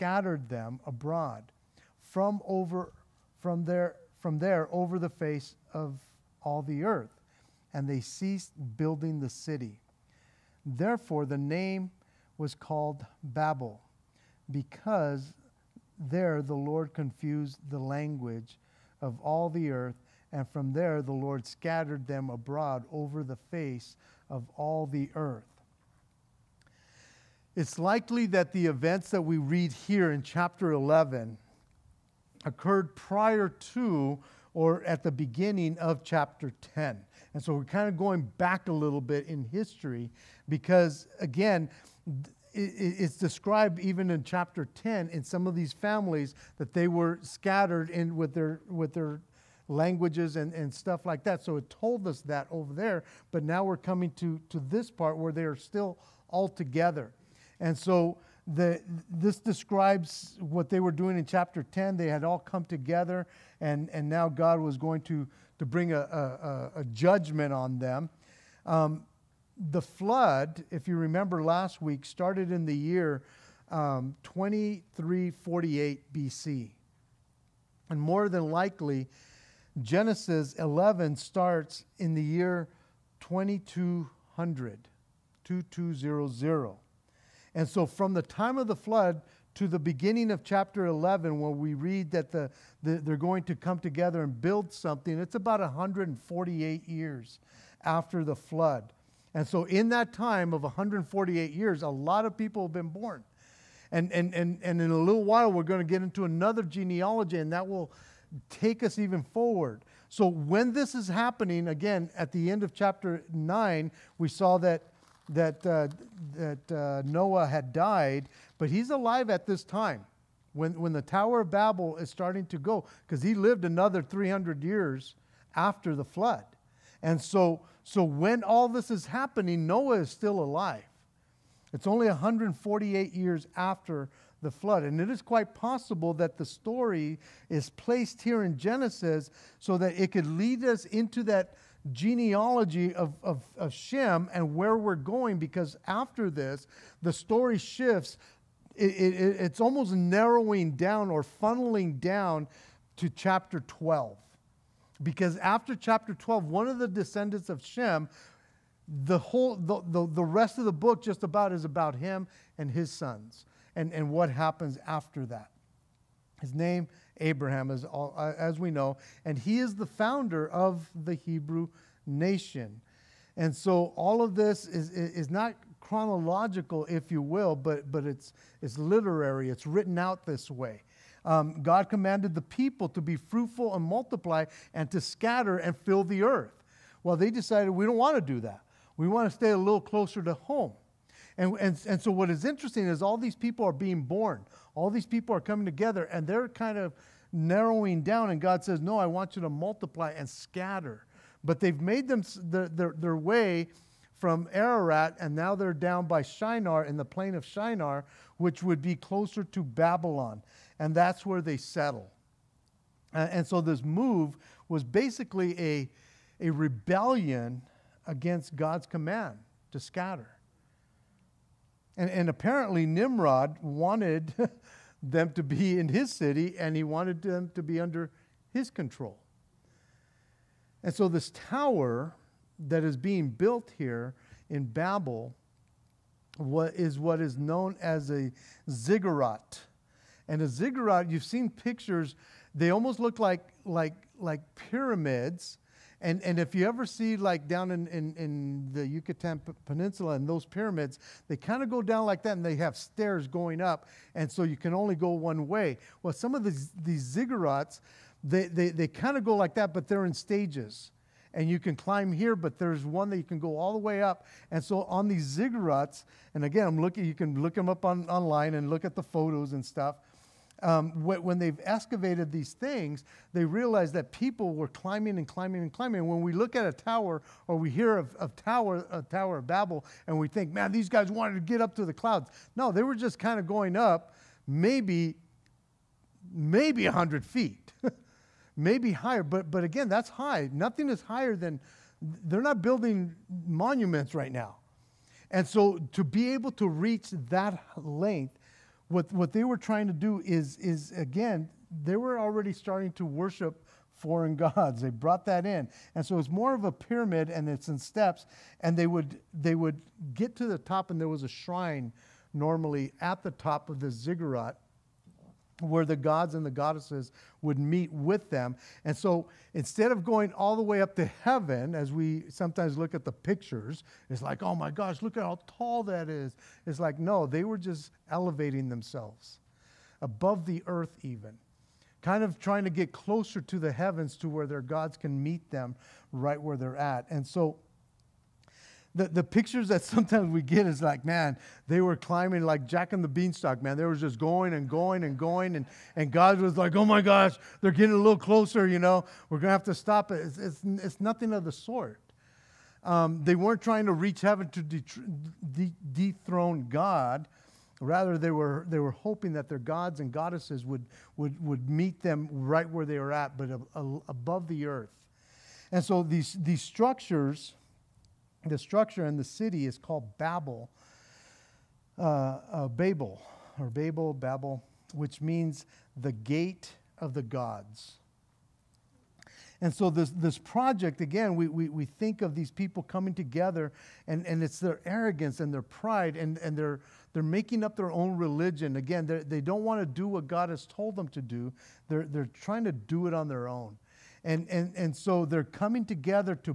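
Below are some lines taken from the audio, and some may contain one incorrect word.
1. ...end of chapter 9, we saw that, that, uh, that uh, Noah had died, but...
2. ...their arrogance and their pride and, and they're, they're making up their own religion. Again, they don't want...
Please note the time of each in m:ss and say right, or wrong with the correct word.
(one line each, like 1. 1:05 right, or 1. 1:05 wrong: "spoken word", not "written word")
1. 1:52 right
2. 6:24 right.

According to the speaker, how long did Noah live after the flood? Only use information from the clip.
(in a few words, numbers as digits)
300 years.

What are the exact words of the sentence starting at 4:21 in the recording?
And you can climb here, but there's one that you can go all the way up.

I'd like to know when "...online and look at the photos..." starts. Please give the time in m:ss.
4:28.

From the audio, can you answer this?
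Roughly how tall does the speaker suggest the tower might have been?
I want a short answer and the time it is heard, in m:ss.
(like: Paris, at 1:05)
100 feet, at 4:46.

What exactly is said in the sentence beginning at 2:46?
His name, Abraham, is all, uh, as we know, and he is the founder of the Hebrew nation.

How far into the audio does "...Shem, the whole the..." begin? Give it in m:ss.
2:37.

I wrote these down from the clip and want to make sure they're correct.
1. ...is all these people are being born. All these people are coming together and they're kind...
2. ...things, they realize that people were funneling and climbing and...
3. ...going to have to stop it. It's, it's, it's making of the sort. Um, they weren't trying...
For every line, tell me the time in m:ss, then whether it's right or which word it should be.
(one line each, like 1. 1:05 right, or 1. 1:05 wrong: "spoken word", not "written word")
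1. 3:12 right
2. 4:32 wrong: "climbing", not "funneling"
3. 5:49 wrong: "nothing", not "making".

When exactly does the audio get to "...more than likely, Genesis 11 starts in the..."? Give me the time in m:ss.
1:18.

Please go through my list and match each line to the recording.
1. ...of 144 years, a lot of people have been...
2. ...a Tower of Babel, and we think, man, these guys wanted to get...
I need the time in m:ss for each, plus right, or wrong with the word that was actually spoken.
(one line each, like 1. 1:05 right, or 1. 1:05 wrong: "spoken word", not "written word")
1. 1:40 wrong: "148", not "144"
2. 4:38 right.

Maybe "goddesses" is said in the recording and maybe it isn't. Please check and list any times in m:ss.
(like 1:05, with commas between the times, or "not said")
5:16, 6:00.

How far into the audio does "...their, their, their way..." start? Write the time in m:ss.
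3:22.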